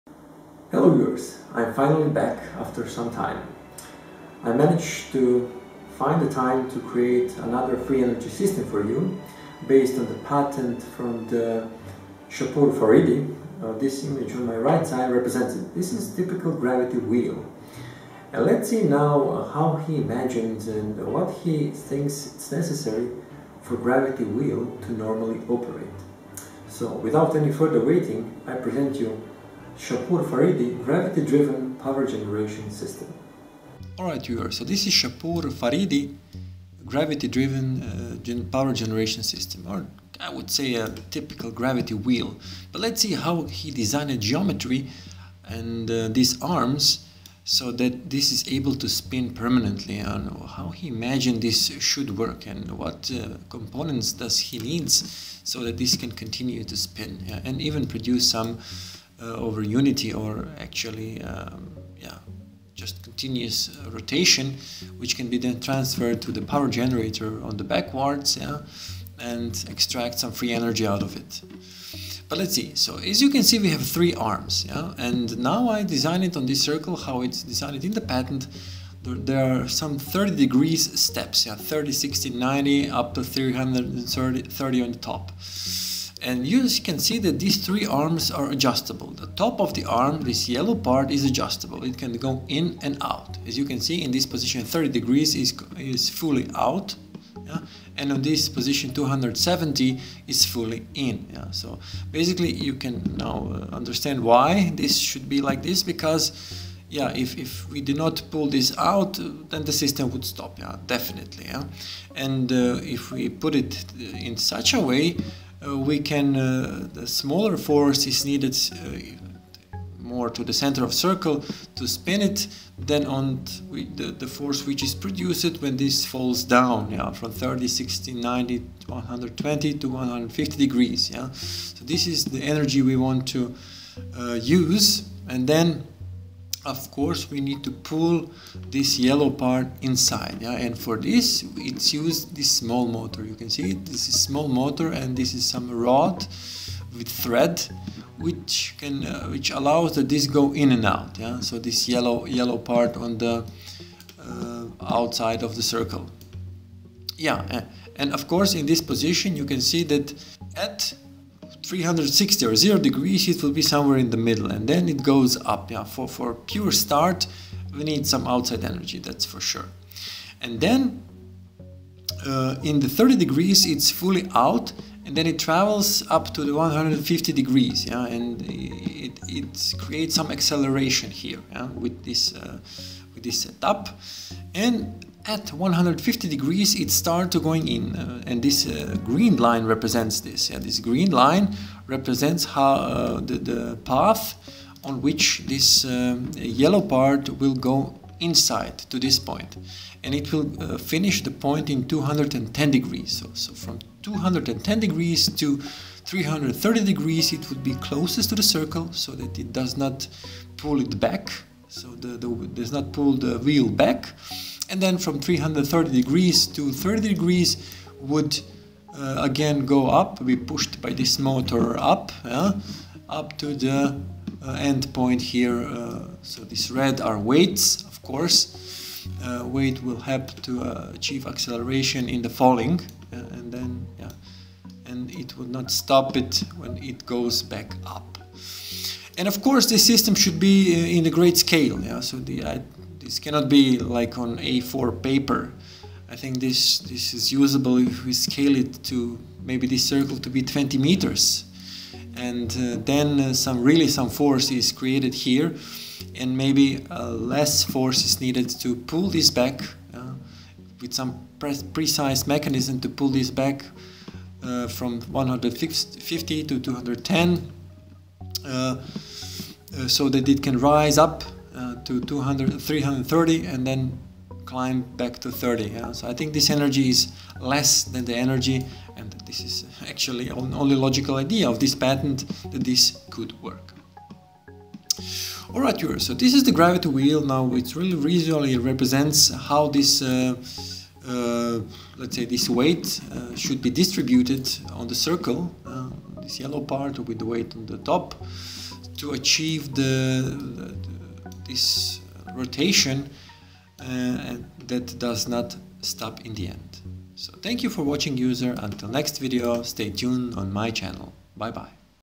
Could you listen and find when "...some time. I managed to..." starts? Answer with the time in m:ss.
0:02.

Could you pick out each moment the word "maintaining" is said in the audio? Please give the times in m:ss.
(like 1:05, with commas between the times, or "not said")
not said.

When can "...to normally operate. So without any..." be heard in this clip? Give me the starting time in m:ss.
0:24.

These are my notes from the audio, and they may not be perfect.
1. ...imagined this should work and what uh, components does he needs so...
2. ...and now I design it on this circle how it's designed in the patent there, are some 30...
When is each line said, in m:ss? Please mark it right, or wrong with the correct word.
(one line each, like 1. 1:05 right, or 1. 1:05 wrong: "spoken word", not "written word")
1. 0:50 right
2. 1:14 right.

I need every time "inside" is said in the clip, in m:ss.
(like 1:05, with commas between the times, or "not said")
2:19, 3:18.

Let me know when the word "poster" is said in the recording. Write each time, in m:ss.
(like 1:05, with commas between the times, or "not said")
not said.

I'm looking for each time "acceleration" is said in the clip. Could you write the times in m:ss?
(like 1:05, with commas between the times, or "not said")
3:00, 3:51.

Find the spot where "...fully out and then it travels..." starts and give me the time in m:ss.
2:53.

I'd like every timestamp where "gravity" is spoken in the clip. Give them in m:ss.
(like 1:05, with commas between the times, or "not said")
0:16, 0:23, 0:30, 0:36, 0:41, 4:46.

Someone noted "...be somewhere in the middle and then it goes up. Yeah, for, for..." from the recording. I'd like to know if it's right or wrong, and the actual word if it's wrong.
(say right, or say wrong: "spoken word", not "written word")
right.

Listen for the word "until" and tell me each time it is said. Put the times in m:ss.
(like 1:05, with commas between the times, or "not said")
5:08.